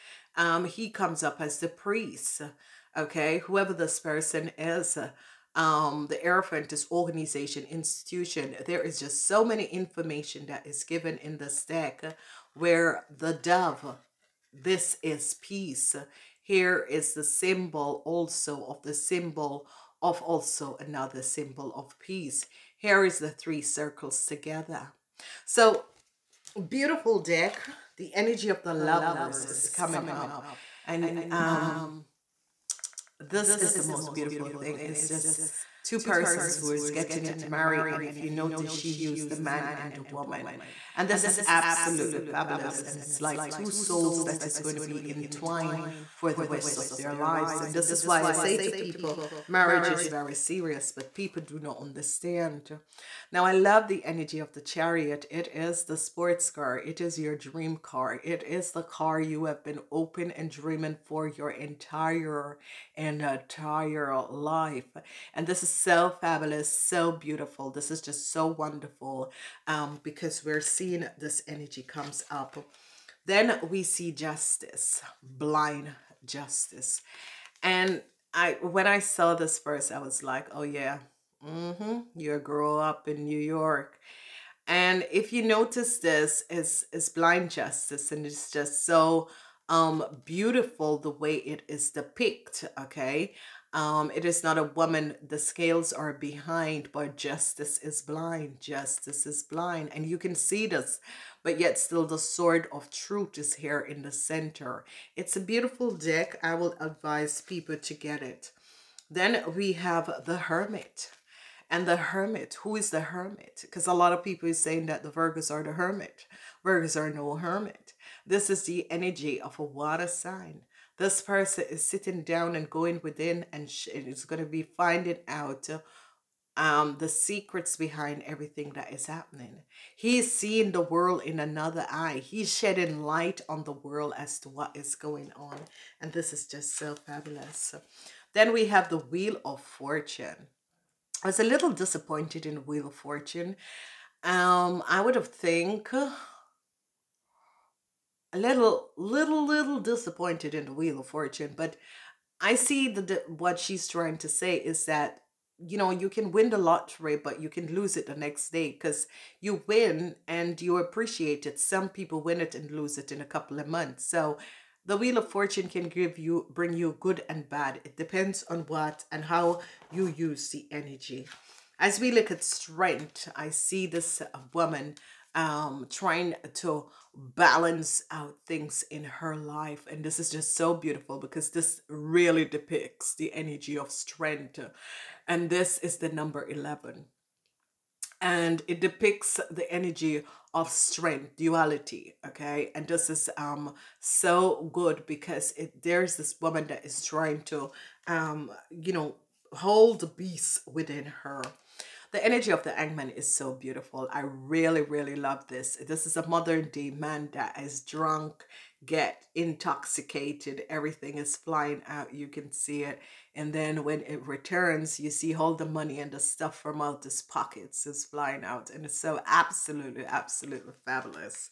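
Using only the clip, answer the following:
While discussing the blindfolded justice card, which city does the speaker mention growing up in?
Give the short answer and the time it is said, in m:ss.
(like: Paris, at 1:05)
New York, at 1:23.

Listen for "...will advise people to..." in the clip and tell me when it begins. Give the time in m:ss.
1:46.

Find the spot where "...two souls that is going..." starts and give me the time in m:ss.
0:43.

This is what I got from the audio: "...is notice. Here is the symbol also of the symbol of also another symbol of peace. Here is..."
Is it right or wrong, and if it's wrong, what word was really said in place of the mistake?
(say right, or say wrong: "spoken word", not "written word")
wrong: "peace", not "notice".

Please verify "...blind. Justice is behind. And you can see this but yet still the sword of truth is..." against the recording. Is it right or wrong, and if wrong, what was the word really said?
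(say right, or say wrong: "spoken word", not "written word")
wrong: "blind", not "behind".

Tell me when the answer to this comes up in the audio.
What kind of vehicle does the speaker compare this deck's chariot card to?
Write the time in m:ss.
0:55.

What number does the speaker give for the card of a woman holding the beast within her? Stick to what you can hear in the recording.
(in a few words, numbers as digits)
11.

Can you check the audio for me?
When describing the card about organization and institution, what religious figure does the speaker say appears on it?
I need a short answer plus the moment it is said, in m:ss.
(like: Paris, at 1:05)
the priest, at 0:01.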